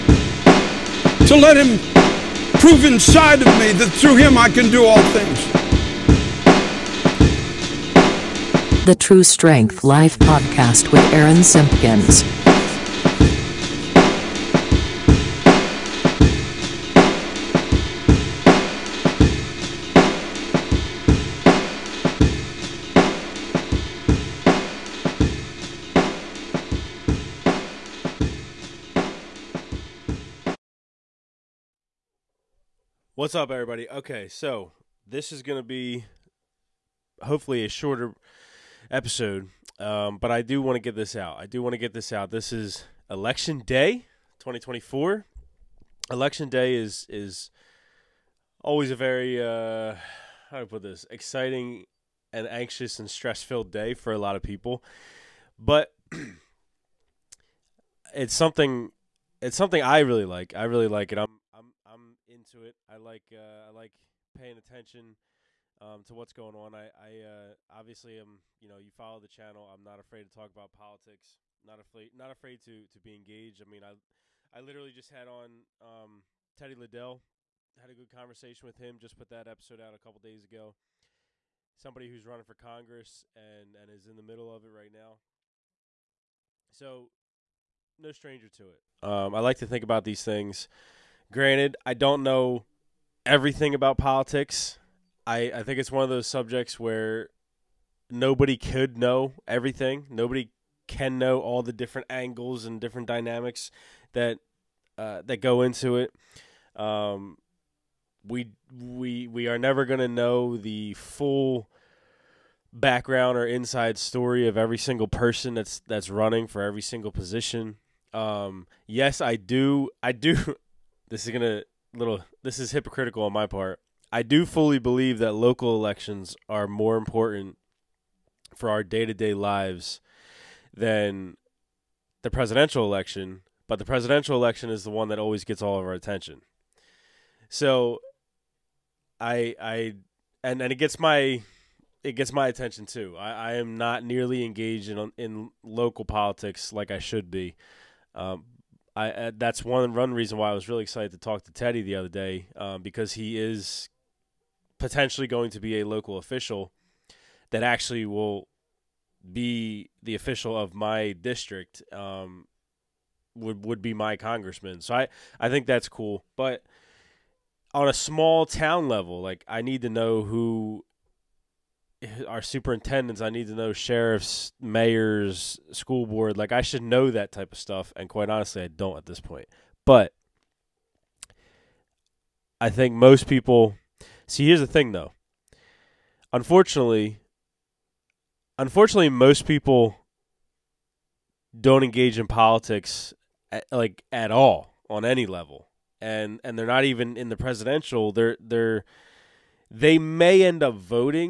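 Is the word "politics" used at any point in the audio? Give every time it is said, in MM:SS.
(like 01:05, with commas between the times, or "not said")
01:10, 01:33, 02:26, 03:12.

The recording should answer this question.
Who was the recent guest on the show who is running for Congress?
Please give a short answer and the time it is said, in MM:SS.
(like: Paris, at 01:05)
Teddy Liddell, at 01:16.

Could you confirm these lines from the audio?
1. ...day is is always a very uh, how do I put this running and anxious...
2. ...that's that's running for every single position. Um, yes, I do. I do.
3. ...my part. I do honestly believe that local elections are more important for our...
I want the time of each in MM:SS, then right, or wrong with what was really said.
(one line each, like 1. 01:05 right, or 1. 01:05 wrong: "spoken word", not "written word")
1. 00:46 wrong: "exciting", not "running"
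2. 01:55 right
3. 02:03 wrong: "fully", not "honestly".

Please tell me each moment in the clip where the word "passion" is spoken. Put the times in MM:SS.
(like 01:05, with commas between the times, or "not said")
not said.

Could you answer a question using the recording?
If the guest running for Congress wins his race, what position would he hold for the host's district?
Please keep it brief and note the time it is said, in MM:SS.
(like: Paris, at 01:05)
congressman, at 02:44.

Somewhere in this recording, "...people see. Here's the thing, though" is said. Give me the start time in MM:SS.
03:03.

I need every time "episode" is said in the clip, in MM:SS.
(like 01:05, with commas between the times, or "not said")
00:38, 01:19.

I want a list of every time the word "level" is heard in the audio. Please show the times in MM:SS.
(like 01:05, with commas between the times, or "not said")
02:48, 03:15.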